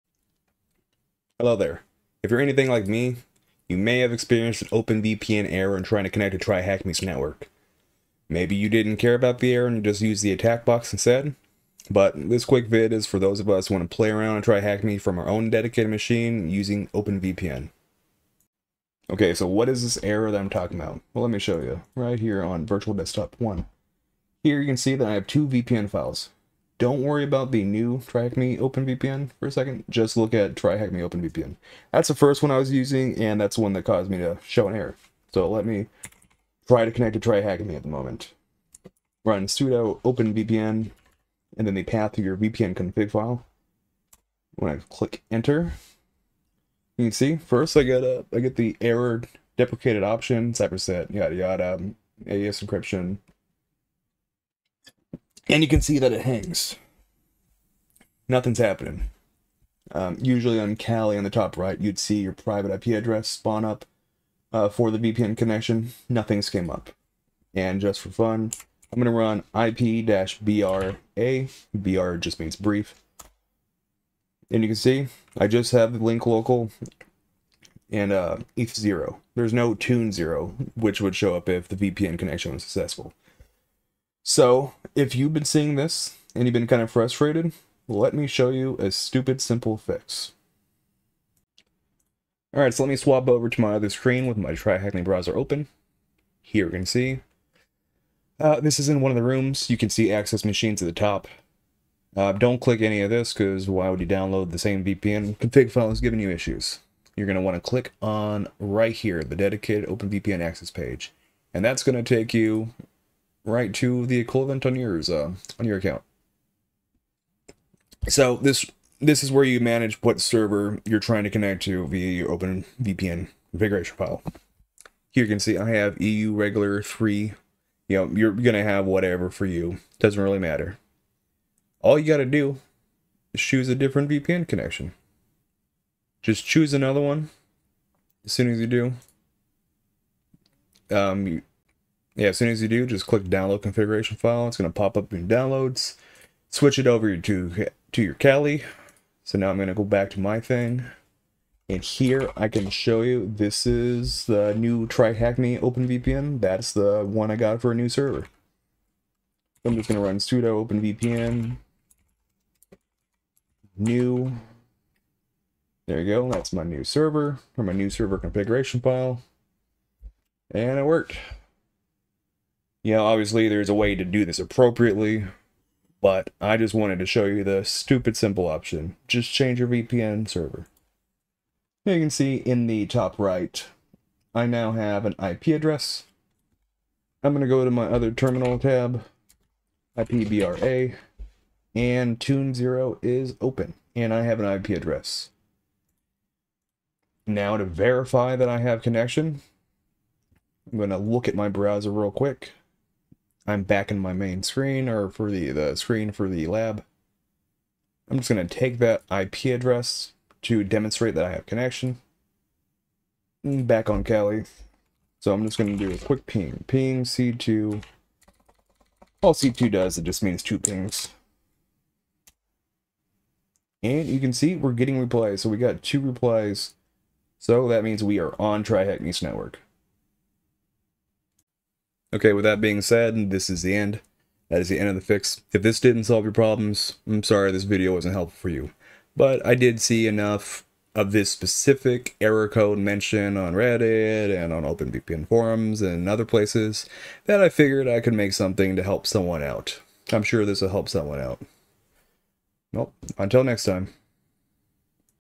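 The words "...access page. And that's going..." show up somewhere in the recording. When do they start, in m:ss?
1:50.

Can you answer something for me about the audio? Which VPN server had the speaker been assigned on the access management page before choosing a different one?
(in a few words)
EU regular 3.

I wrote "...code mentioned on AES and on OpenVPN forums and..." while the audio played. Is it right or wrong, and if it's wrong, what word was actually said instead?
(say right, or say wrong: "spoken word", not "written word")
wrong: "Reddit", not "AES".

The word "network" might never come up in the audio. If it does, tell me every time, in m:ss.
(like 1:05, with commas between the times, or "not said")
0:07, 3:49.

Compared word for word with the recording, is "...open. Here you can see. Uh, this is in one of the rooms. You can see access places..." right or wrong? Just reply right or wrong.
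wrong.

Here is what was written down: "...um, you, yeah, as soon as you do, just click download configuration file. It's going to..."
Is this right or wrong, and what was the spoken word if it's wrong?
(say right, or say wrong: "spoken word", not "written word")
right.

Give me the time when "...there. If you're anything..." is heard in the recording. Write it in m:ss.
0:01.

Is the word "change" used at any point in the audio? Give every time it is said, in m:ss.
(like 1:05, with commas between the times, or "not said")
2:59.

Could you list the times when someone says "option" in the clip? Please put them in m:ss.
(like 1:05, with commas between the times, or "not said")
0:50, 2:58.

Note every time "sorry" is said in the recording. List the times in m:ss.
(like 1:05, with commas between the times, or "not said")
3:57.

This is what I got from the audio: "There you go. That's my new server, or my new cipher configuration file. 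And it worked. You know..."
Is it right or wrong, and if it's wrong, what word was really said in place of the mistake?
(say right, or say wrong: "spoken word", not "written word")
wrong: "server", not "cipher".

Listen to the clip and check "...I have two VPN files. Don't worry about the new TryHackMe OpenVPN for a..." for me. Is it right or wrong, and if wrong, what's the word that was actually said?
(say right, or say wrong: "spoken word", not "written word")
right.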